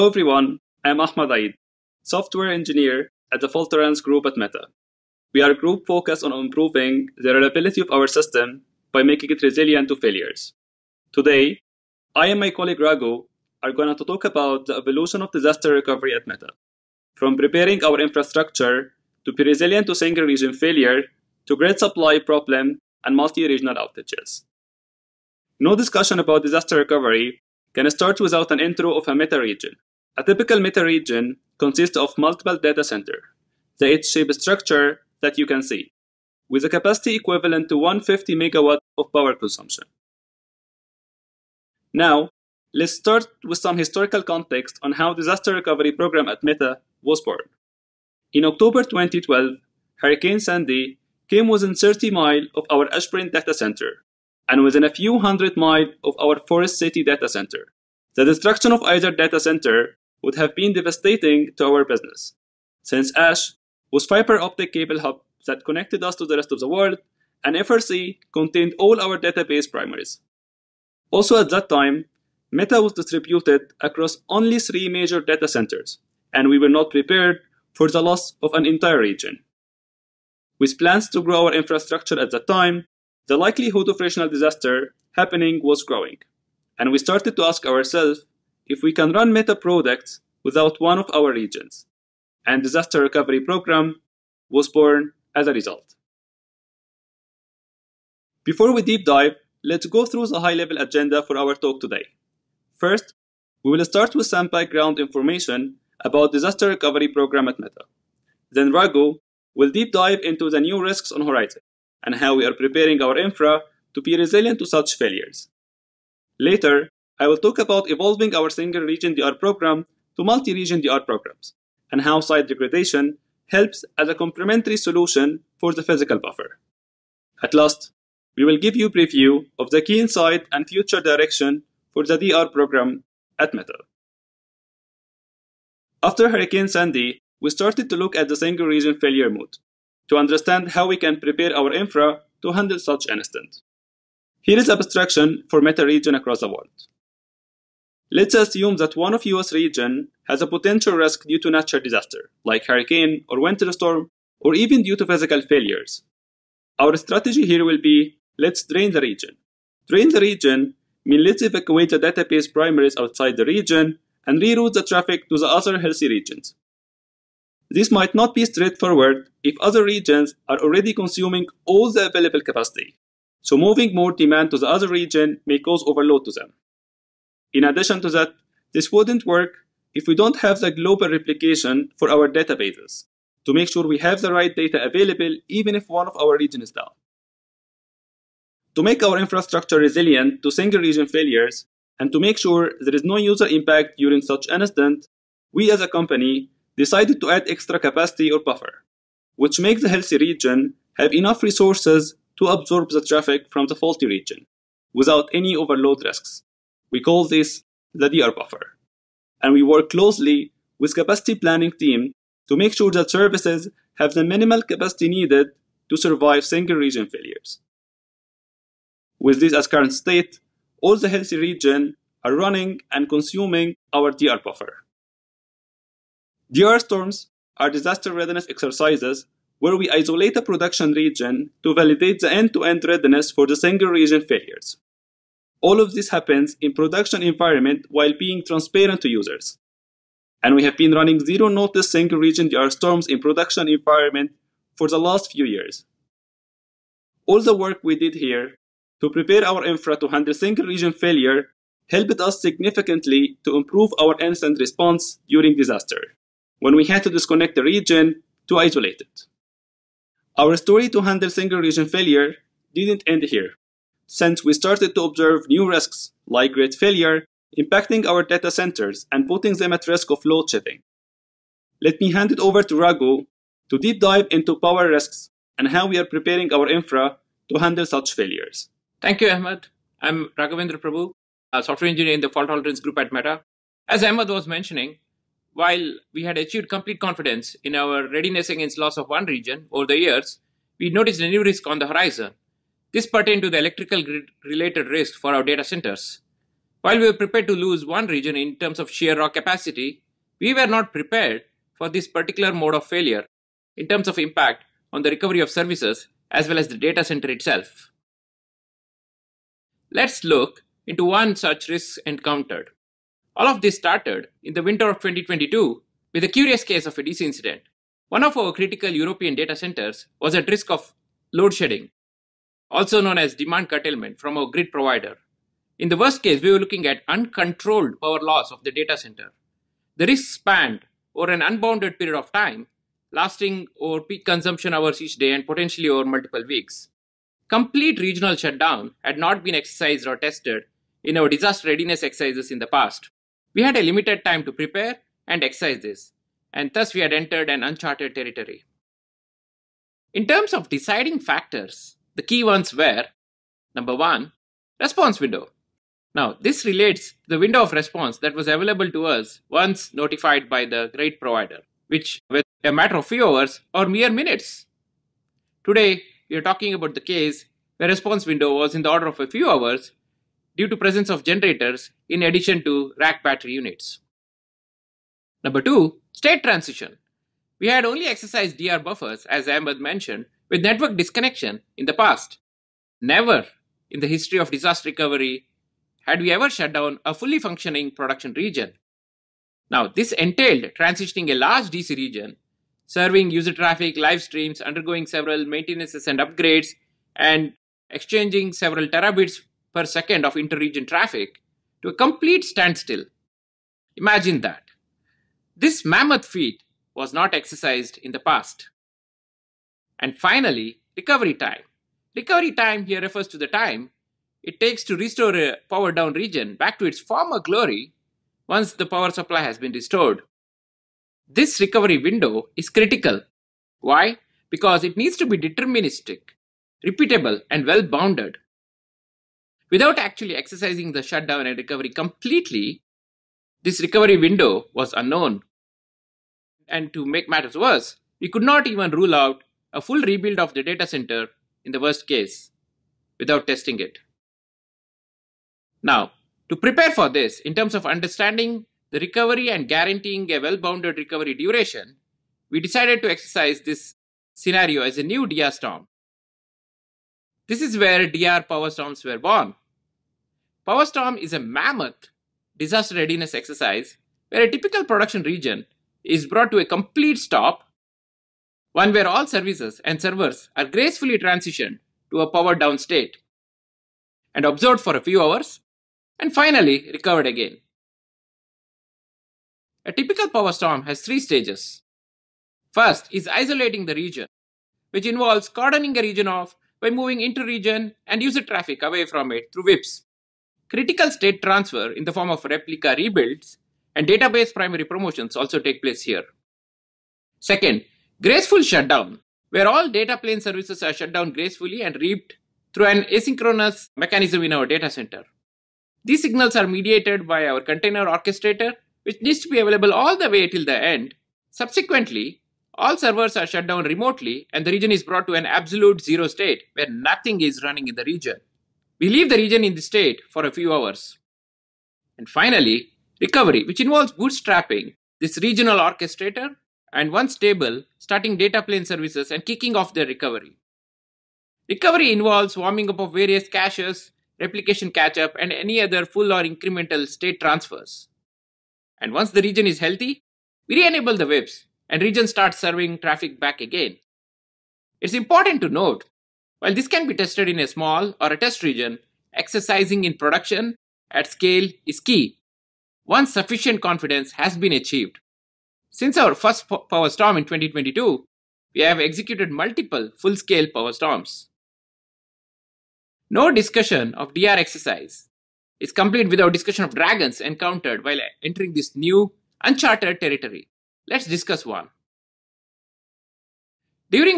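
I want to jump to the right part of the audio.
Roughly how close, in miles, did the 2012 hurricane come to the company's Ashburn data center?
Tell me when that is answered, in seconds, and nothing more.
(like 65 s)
51 s.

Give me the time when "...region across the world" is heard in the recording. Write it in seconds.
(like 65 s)
145 s.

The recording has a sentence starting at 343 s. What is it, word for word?
We had a limited time to prepare and exercise this, and thus we had entered an uncharted territory.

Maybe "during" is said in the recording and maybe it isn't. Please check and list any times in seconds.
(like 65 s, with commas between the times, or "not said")
193 s, 255 s.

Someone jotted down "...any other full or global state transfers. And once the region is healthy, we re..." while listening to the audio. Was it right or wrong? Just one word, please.
wrong.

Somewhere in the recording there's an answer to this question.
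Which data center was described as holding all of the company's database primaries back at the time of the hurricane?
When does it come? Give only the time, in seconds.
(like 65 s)
56 s.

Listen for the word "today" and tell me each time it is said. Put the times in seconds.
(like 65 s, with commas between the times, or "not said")
11 s, 101 s, 365 s.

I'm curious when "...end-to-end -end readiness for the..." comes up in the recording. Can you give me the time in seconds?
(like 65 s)
232 s.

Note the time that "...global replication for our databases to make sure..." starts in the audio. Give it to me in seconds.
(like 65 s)
180 s.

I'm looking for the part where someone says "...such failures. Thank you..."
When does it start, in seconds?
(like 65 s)
277 s.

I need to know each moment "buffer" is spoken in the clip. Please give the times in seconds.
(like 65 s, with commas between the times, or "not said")
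126 s, 198 s, 208 s, 224 s, 378 s.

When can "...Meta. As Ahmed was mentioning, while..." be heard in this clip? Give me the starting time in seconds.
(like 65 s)
283 s.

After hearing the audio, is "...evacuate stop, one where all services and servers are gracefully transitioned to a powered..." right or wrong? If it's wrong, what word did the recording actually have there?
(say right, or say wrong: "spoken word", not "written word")
wrong: "complete", not "evacuate".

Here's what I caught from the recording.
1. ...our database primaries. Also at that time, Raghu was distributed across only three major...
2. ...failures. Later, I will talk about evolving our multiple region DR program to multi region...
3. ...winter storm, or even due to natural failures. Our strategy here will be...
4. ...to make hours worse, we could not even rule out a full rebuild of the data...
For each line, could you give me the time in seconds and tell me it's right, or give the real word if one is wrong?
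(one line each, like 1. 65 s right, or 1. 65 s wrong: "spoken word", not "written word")
1. 68 s wrong: "Meta", not "Raghu"
2. 114 s wrong: "single", not "multiple"
3. 153 s wrong: "physical", not "natural"
4. 436 s wrong: "matters", not "hours".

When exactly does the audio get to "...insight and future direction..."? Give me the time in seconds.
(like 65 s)
129 s.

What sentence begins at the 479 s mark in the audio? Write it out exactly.
A typical power storm has three stages.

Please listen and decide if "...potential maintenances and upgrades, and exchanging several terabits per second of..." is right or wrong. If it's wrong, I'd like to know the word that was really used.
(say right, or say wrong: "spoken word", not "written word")
wrong: "several", not "potential".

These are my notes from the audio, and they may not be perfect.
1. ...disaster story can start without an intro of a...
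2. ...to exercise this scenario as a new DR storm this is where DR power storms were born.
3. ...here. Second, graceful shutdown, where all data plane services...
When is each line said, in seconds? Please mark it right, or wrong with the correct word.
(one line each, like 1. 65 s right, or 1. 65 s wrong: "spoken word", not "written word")
1. 26 s wrong: "recovery", not "story"
2. 453 s right
3. 496 s right.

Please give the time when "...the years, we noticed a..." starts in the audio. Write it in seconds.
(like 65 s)
289 s.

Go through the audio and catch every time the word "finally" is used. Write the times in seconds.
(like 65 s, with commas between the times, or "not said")
410 s, 476 s, 522 s.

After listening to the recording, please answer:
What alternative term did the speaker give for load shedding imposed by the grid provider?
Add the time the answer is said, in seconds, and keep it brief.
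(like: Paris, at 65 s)
demand curtailment, at 323 s.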